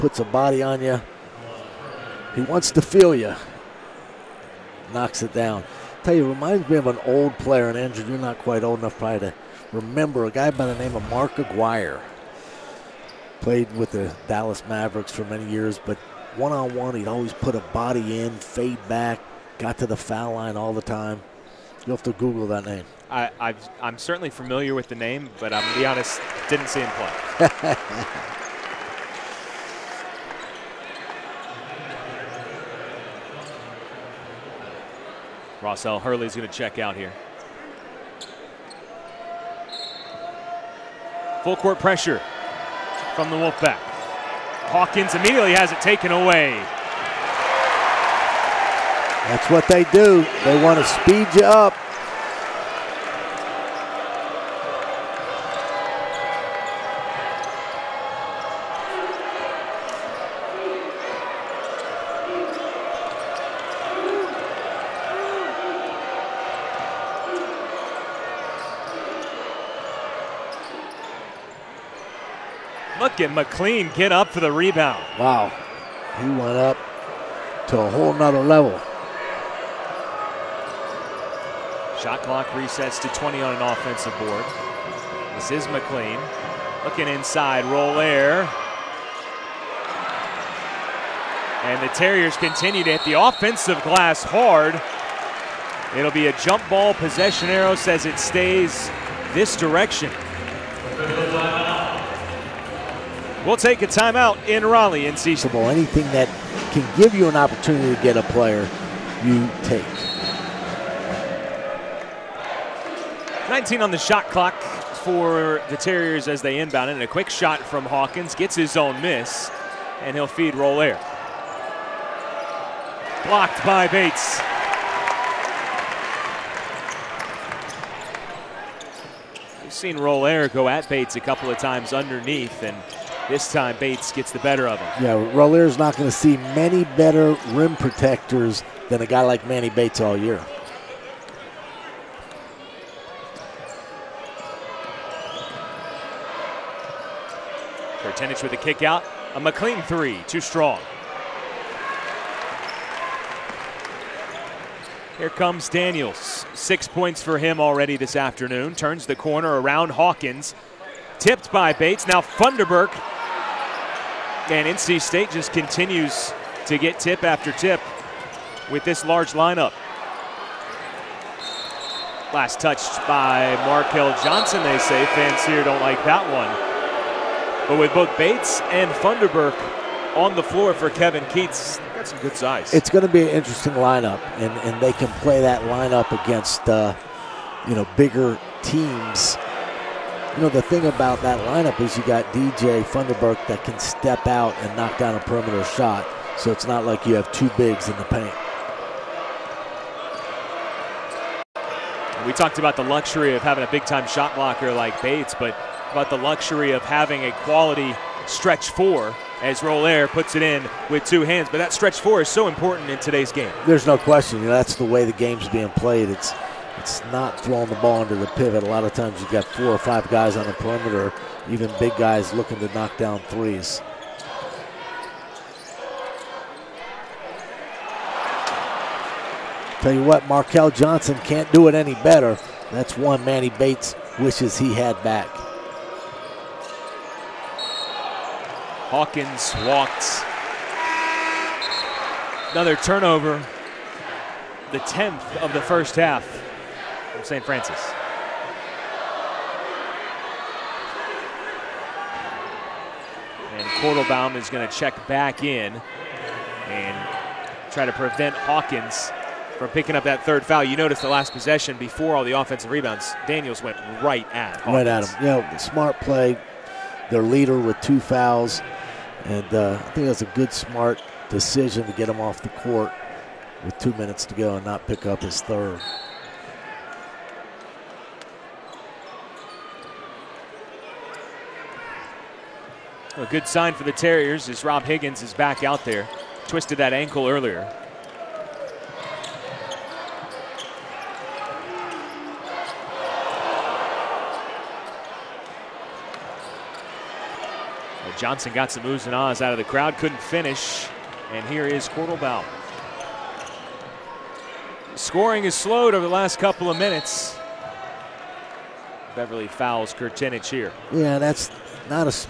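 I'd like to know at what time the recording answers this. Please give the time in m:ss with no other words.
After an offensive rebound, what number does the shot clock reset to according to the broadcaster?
1:23.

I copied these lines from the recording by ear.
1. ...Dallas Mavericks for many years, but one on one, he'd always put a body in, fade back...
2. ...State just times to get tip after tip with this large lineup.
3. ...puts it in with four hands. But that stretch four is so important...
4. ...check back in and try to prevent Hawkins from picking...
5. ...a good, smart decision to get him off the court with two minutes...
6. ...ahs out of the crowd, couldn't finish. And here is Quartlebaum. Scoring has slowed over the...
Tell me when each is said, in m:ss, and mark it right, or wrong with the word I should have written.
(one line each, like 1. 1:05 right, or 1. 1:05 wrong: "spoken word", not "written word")
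1. 0:14 right
2. 2:44 wrong: "continues", not "times"
3. 3:30 wrong: "two", not "four"
4. 4:14 right
5. 4:30 right
6. 4:59 right.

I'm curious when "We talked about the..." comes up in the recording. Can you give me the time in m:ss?
3:22.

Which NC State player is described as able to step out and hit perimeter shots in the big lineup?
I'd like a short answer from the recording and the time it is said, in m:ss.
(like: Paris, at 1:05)
DJ Funderburk, at 3:12.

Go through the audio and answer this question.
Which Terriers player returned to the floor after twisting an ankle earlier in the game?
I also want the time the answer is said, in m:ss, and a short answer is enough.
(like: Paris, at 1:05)
Rob Higgins, at 4:44.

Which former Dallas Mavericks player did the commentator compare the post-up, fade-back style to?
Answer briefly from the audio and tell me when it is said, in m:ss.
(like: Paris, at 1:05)
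Mark Aguirre, at 0:11.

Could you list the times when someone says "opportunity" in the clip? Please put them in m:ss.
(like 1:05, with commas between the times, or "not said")
1:47.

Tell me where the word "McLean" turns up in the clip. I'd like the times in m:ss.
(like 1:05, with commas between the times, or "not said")
1:13, 1:25, 2:29.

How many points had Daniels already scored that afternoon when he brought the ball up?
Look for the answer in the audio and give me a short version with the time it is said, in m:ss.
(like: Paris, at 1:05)
6, at 2:36.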